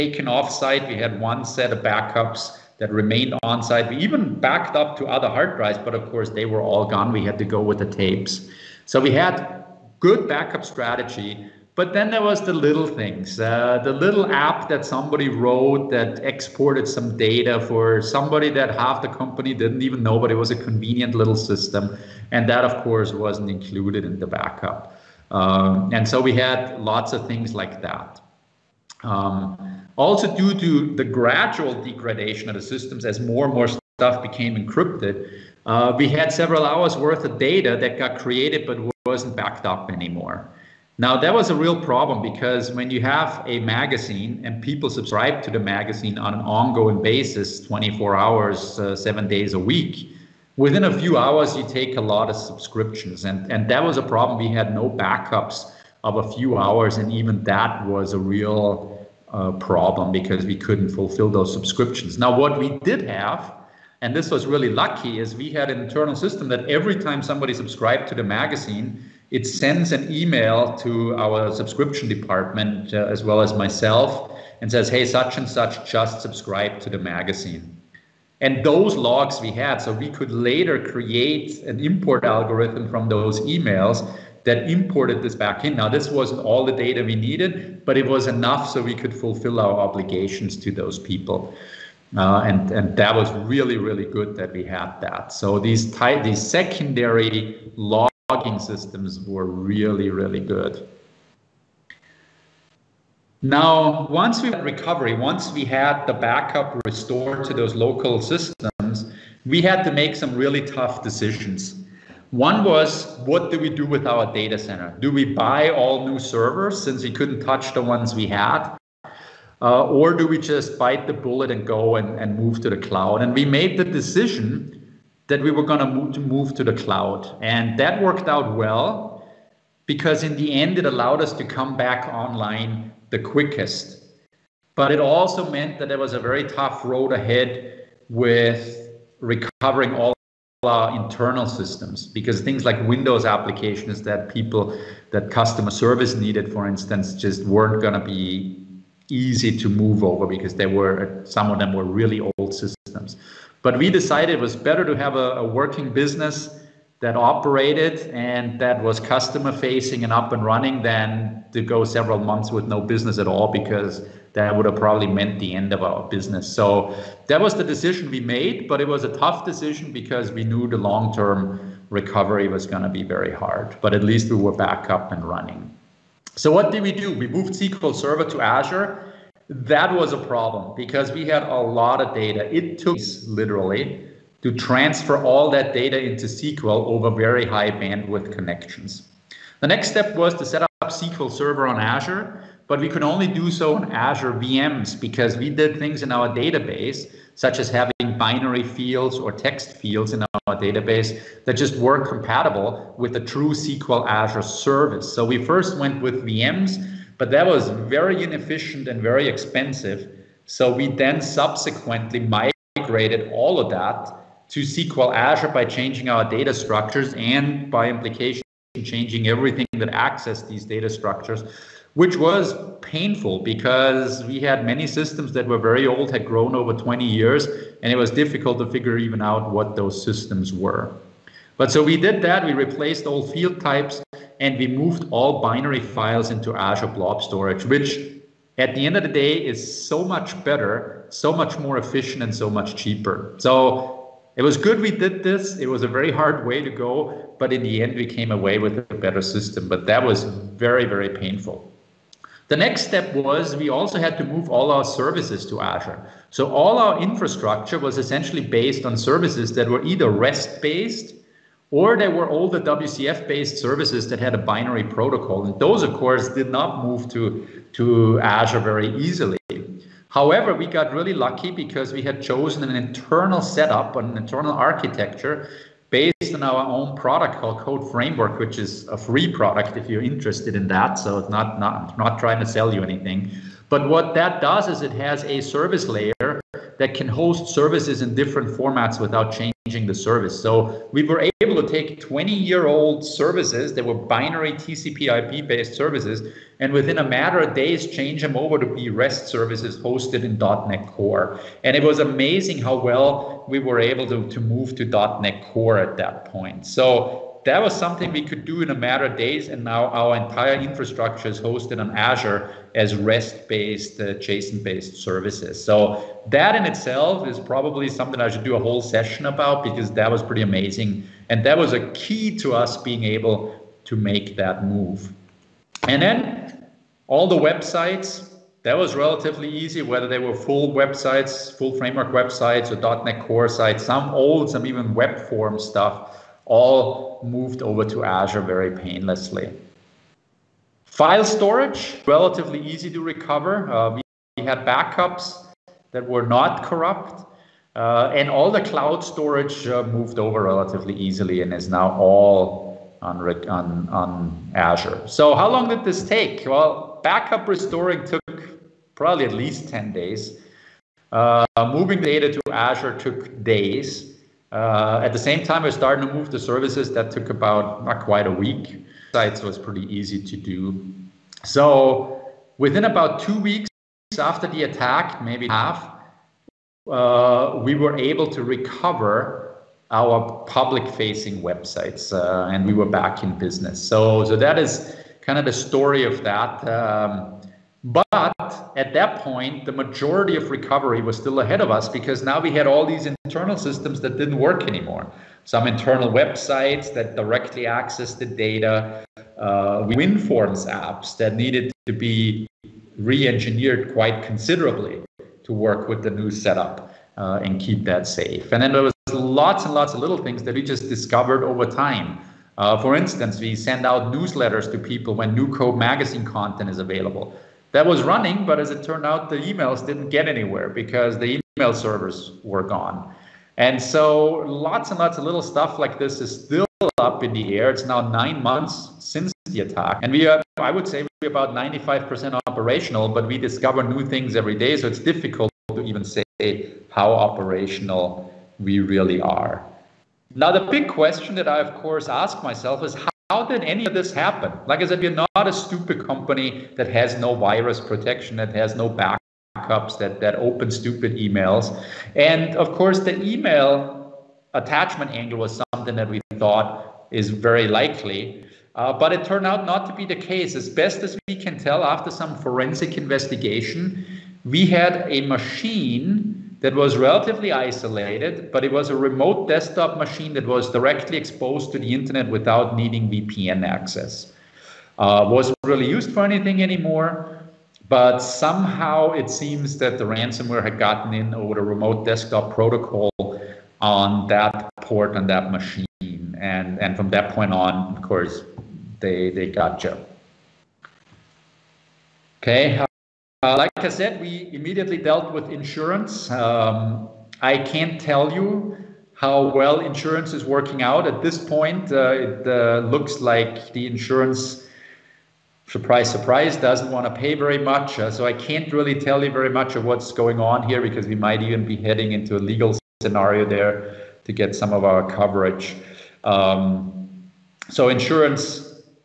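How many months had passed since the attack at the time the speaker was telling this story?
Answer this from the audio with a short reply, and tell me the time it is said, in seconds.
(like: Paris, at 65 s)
9, at 428 s.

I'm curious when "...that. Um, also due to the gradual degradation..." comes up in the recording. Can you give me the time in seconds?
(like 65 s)
27 s.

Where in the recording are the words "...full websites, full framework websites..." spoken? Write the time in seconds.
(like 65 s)
330 s.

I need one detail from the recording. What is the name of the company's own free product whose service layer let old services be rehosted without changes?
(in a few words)
Code Framework.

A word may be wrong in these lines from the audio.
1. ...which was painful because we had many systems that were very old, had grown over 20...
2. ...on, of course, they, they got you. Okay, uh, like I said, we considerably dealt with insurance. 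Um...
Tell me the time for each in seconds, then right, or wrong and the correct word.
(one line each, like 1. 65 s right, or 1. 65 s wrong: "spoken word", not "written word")
1. 221 s right
2. 487 s wrong: "immediately", not "considerably".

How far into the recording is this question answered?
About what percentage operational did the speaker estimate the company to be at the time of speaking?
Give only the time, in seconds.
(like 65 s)
431 s.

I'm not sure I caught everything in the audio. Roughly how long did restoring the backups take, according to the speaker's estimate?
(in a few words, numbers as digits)
At least 10 days.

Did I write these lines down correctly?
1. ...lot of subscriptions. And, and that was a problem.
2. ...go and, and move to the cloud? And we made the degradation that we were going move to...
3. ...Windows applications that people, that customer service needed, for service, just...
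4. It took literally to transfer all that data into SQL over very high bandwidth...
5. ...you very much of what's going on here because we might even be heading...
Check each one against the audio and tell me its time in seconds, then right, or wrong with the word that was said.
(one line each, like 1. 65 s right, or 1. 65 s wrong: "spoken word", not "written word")
1. 52 s right
2. 121 s wrong: "decision", not "degradation"
3. 142 s wrong: "instance", not "service"
4. 182 s right
5. 509 s right.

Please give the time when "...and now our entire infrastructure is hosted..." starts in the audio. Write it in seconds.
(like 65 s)
309 s.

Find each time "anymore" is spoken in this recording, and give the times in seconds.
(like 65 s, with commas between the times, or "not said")
39 s, 394 s, 476 s.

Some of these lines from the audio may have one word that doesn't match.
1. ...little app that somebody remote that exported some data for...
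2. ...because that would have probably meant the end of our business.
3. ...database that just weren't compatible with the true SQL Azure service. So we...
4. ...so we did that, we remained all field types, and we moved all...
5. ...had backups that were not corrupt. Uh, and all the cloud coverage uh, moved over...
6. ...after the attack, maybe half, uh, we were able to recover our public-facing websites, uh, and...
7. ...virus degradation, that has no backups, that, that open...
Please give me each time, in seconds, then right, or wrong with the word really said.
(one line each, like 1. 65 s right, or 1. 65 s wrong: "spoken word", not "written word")
1. 13 s wrong: "wrote", not "remote"
2. 163 s right
3. 200 s right
4. 231 s wrong: "replaced", not "remained"
5. 344 s wrong: "storage", not "coverage"
6. 374 s right
7. 447 s wrong: "protection", not "degradation".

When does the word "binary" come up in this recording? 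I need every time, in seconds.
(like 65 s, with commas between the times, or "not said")
198 s, 235 s, 264 s, 293 s.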